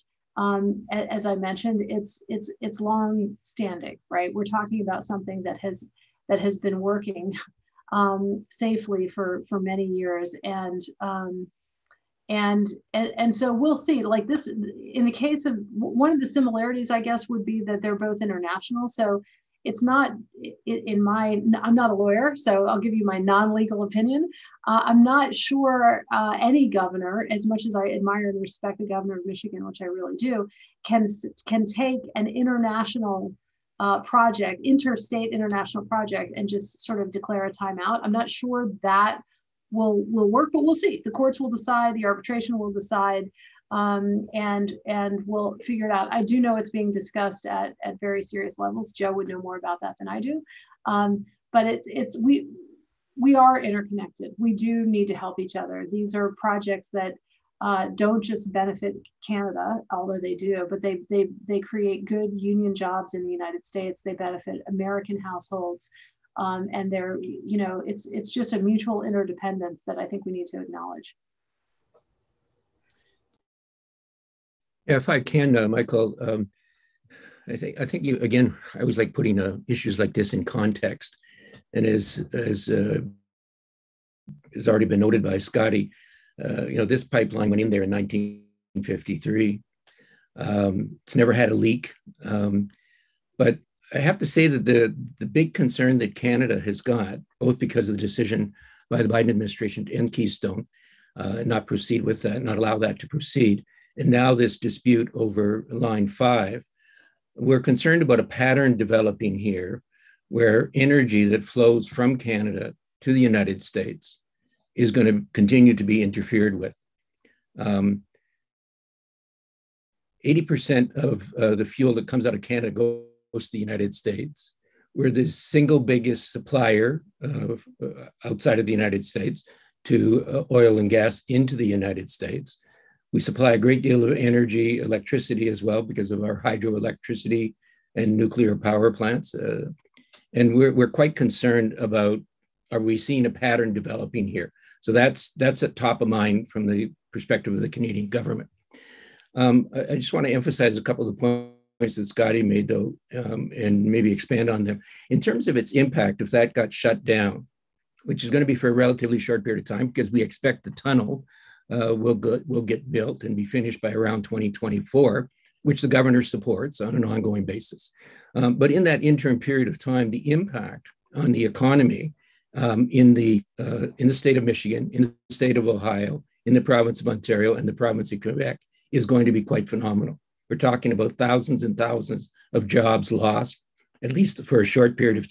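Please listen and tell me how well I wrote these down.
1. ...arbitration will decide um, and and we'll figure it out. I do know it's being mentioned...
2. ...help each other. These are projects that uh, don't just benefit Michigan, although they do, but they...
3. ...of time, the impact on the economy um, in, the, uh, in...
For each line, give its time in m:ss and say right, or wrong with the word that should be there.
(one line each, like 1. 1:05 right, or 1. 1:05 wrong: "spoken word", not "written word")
1. 0:42 wrong: "discussed", not "mentioned"
2. 0:55 wrong: "Canada", not "Michigan"
3. 2:49 right.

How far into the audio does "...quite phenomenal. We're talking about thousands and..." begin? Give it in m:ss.
2:59.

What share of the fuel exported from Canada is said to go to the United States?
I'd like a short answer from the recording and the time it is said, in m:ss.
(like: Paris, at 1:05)
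80%, at 1:57.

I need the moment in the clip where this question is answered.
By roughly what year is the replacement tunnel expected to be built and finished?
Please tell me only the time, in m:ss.
2:44.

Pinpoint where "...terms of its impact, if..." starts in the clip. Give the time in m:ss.
2:35.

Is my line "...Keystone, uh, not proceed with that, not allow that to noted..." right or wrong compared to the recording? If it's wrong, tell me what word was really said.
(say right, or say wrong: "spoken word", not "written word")
wrong: "proceed", not "noted".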